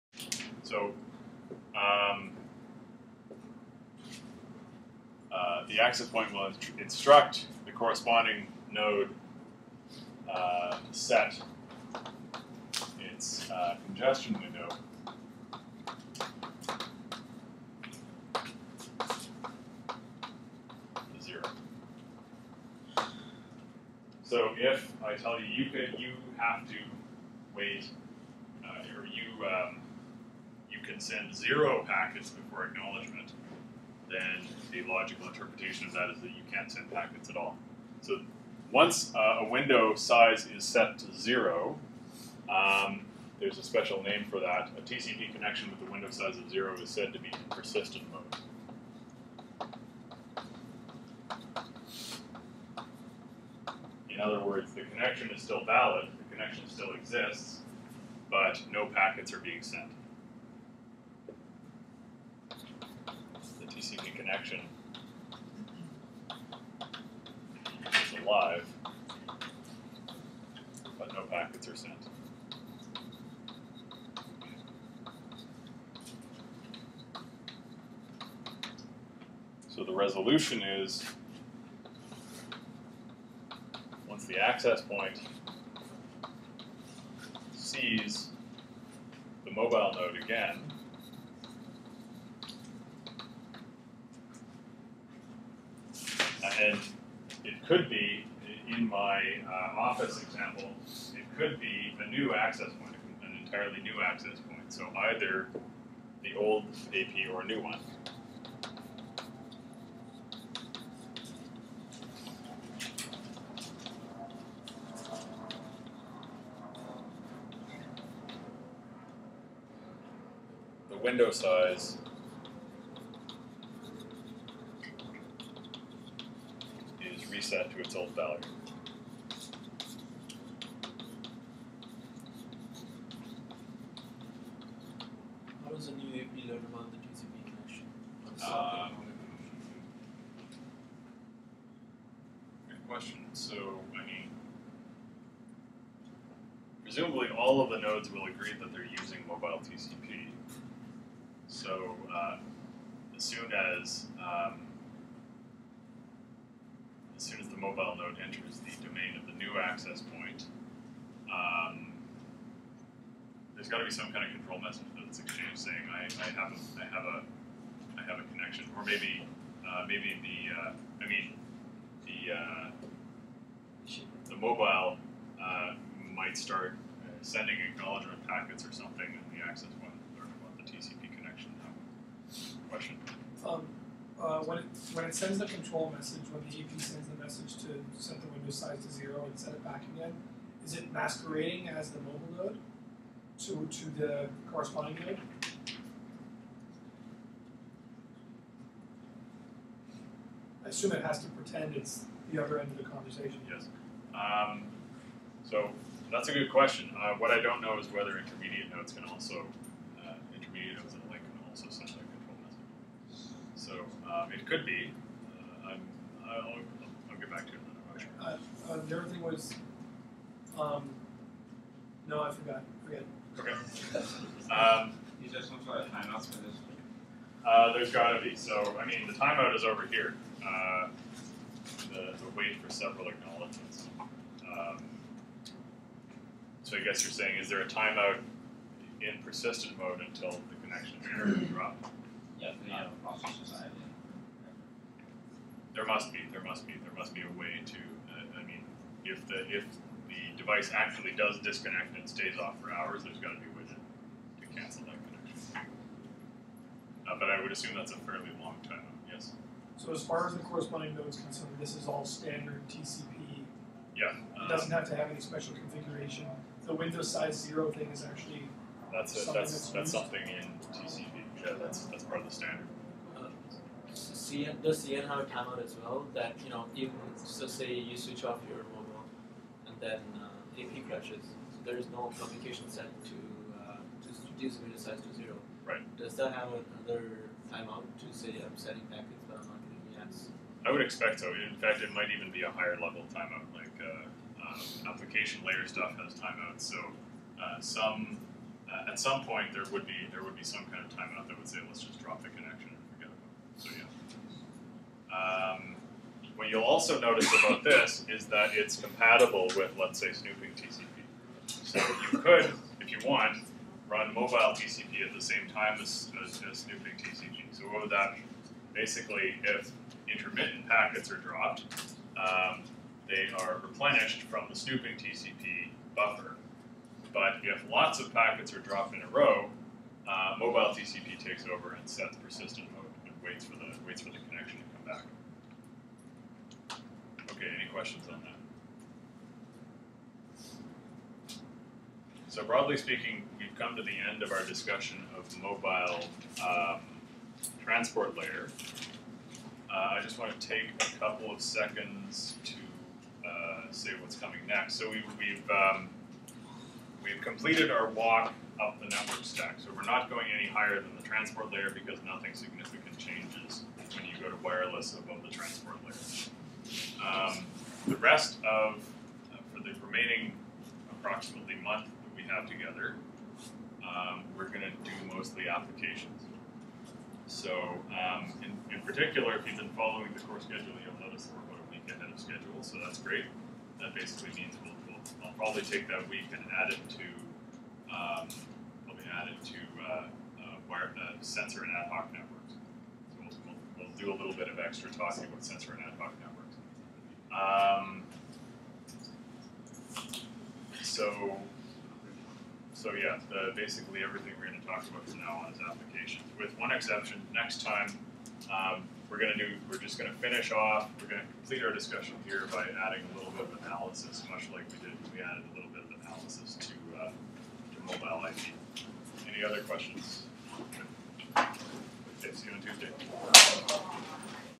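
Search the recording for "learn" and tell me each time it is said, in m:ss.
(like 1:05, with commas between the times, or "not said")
2:16, 3:00.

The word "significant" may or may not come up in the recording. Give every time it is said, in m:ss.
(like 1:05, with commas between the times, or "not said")
6:02.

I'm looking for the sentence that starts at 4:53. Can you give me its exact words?
Like uh, um, application layer stuff has timeouts.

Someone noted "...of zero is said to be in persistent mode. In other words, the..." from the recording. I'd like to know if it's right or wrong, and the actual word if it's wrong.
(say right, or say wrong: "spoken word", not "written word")
right.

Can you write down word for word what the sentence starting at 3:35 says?
Uh, I'm, I'll, I'll get back to it another question.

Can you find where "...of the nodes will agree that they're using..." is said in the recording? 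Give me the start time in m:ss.
2:27.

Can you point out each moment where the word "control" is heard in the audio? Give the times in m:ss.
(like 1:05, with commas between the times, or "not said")
2:44, 3:05.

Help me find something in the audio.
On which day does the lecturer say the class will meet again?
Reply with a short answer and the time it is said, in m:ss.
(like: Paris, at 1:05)
Tuesday, at 7:02.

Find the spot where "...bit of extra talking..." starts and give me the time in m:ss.
6:34.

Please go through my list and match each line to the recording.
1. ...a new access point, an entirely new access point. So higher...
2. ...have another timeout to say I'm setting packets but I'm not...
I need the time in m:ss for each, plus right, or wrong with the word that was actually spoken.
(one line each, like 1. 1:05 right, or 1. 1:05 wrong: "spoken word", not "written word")
1. 1:42 wrong: "either", not "higher"
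2. 4:46 right.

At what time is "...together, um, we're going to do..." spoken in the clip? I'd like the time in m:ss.
6:12.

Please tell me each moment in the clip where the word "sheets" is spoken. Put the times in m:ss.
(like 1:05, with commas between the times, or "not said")
not said.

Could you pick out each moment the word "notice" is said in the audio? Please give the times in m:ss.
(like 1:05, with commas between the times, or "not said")
5:06, 6:21.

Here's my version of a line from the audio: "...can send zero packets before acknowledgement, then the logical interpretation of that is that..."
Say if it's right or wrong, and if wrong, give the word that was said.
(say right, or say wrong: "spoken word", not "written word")
right.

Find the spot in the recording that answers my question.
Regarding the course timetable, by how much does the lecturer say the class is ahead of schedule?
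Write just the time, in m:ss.
6:21.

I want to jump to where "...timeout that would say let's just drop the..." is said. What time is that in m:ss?
5:00.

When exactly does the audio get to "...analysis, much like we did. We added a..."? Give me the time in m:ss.
6:53.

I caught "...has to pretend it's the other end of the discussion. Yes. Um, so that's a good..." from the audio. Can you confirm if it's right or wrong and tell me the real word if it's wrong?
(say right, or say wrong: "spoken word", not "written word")
wrong: "conversation", not "discussion".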